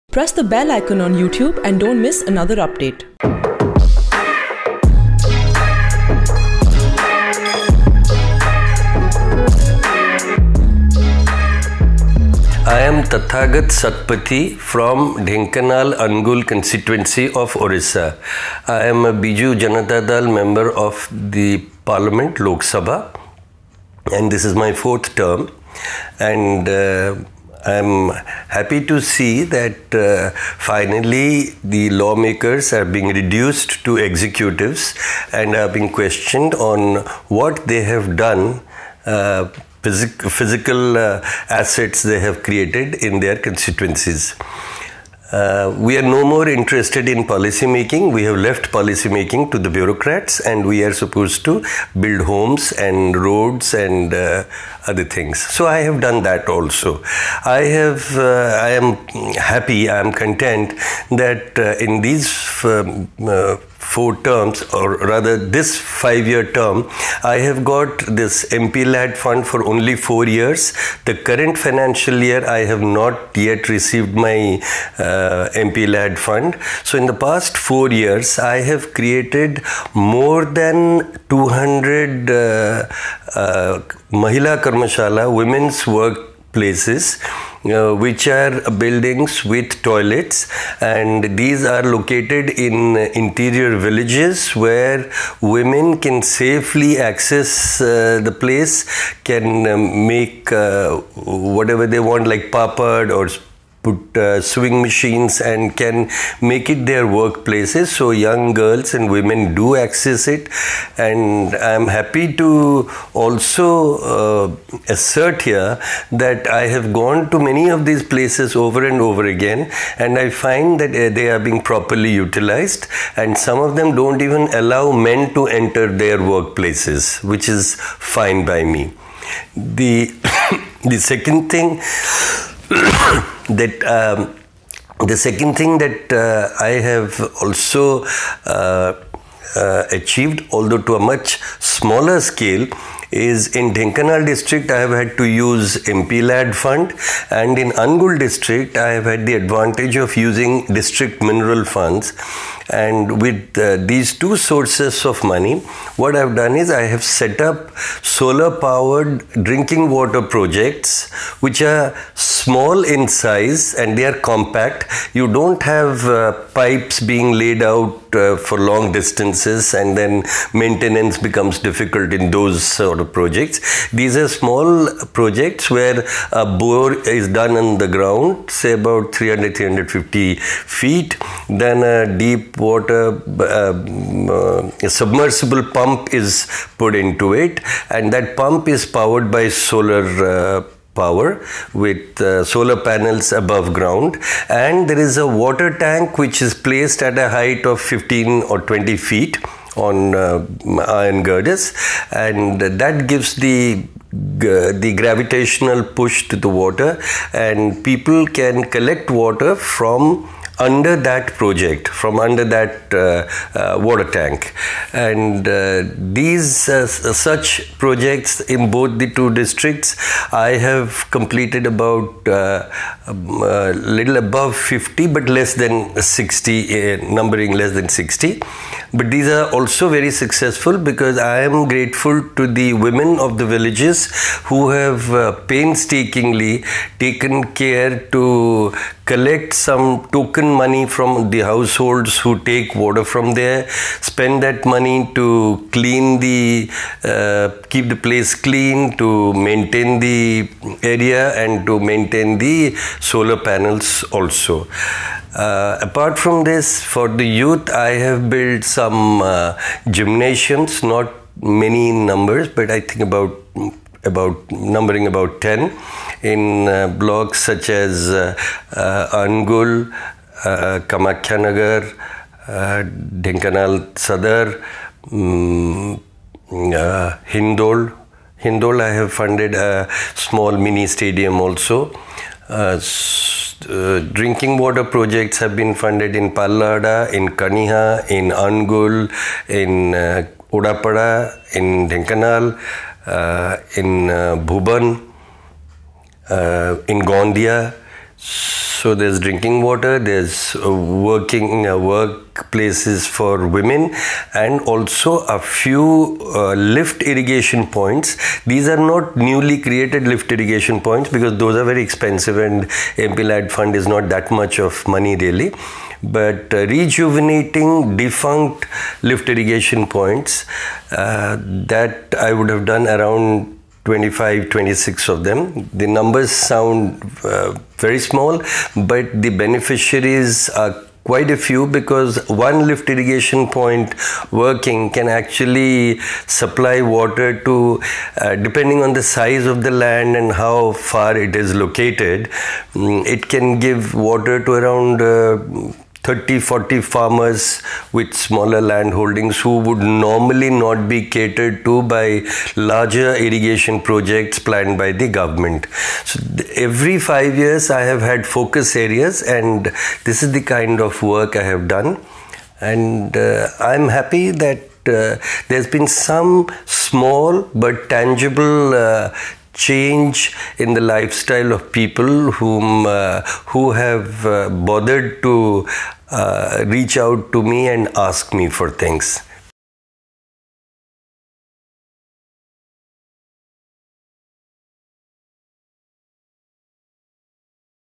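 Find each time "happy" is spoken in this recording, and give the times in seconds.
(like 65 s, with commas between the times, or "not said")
28 s, 59 s, 111 s, 363 s.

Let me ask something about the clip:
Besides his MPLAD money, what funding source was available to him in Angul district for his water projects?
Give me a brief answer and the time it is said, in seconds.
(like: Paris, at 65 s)
district mineral funds, at 150 s.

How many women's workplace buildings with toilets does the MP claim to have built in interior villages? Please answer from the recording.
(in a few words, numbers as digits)
more than 200.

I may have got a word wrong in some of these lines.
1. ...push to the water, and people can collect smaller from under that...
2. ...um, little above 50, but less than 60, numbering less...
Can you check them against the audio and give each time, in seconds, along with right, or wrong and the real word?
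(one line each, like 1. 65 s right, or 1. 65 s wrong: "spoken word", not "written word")
1. 205 s wrong: "water", not "smaller"
2. 222 s right.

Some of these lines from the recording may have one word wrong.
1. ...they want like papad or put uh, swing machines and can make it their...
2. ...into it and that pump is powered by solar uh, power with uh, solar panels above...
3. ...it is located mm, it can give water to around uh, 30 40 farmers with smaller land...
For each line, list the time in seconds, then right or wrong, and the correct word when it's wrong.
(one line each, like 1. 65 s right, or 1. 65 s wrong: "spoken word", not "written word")
1. 101 s right
2. 186 s right
3. 341 s right.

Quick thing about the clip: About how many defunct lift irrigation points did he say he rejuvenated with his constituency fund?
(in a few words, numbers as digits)
25-26.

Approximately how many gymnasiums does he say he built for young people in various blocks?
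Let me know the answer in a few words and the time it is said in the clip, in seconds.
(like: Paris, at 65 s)
10, at 265 s.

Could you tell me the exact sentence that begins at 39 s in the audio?
Uh, phys physical uh, assets they have created in their constituencies.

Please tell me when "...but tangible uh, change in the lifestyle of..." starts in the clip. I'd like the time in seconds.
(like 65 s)
367 s.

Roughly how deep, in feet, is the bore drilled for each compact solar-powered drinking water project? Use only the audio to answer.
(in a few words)
300 to 350 feet.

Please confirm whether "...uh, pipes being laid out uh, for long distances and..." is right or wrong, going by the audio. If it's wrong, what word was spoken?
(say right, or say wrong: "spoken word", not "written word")
right.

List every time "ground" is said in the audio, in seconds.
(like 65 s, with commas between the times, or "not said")
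177 s, 193 s.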